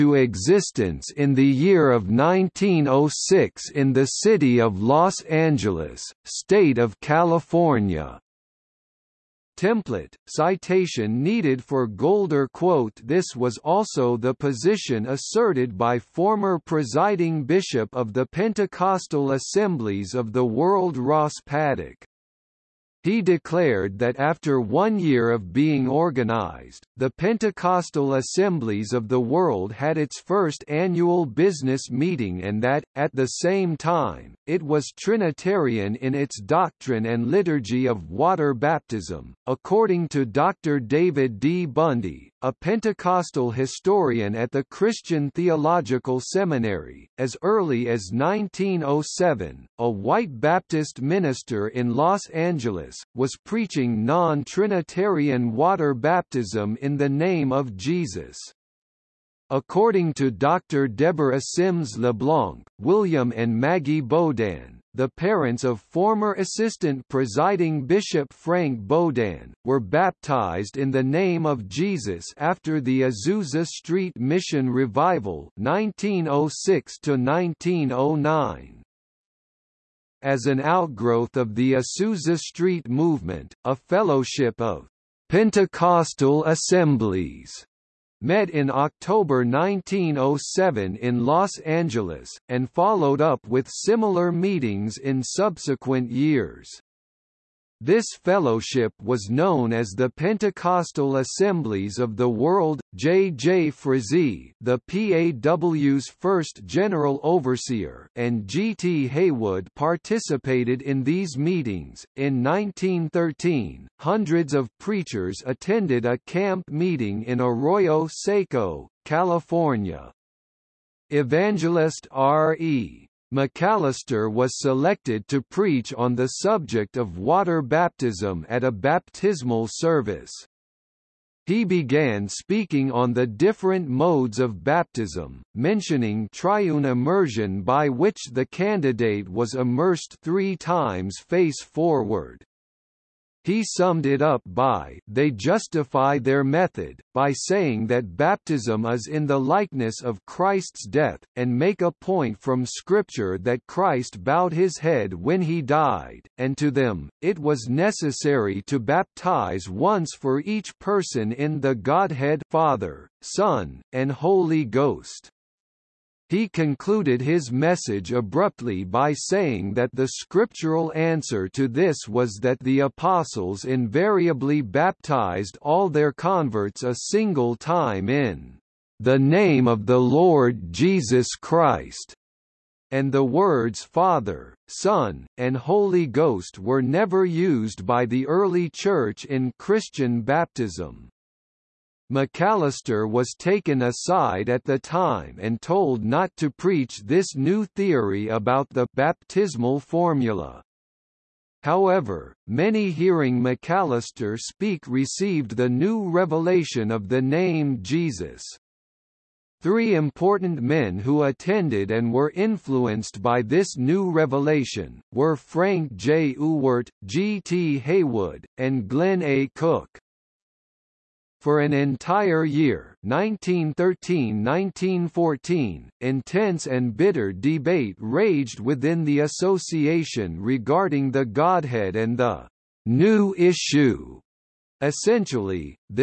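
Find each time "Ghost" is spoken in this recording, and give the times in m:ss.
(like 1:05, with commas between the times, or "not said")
2:44, 3:06.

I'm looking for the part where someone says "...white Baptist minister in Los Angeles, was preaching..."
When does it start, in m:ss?
0:49.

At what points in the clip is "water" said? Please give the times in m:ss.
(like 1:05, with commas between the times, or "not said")
0:38, 0:55, 2:07.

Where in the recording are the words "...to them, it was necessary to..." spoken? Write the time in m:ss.
2:36.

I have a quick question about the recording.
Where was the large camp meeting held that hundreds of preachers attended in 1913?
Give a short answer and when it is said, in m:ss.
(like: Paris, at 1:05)
Arroyo Seco, California, at 1:57.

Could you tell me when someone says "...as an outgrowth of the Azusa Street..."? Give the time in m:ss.
1:20.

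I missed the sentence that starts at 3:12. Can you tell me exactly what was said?
McAllister was taken aside at the time and told not to preach this new theory about the baptismal formula.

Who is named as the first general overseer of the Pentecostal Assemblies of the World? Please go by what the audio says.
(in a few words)
J. J. Frazee.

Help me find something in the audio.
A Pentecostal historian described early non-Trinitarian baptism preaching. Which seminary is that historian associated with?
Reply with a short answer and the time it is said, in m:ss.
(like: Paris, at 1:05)
Christian Theological Seminary, at 0:44.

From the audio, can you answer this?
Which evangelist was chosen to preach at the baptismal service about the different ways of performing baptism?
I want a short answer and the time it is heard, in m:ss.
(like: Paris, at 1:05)
R. E. McAllister, at 2:02.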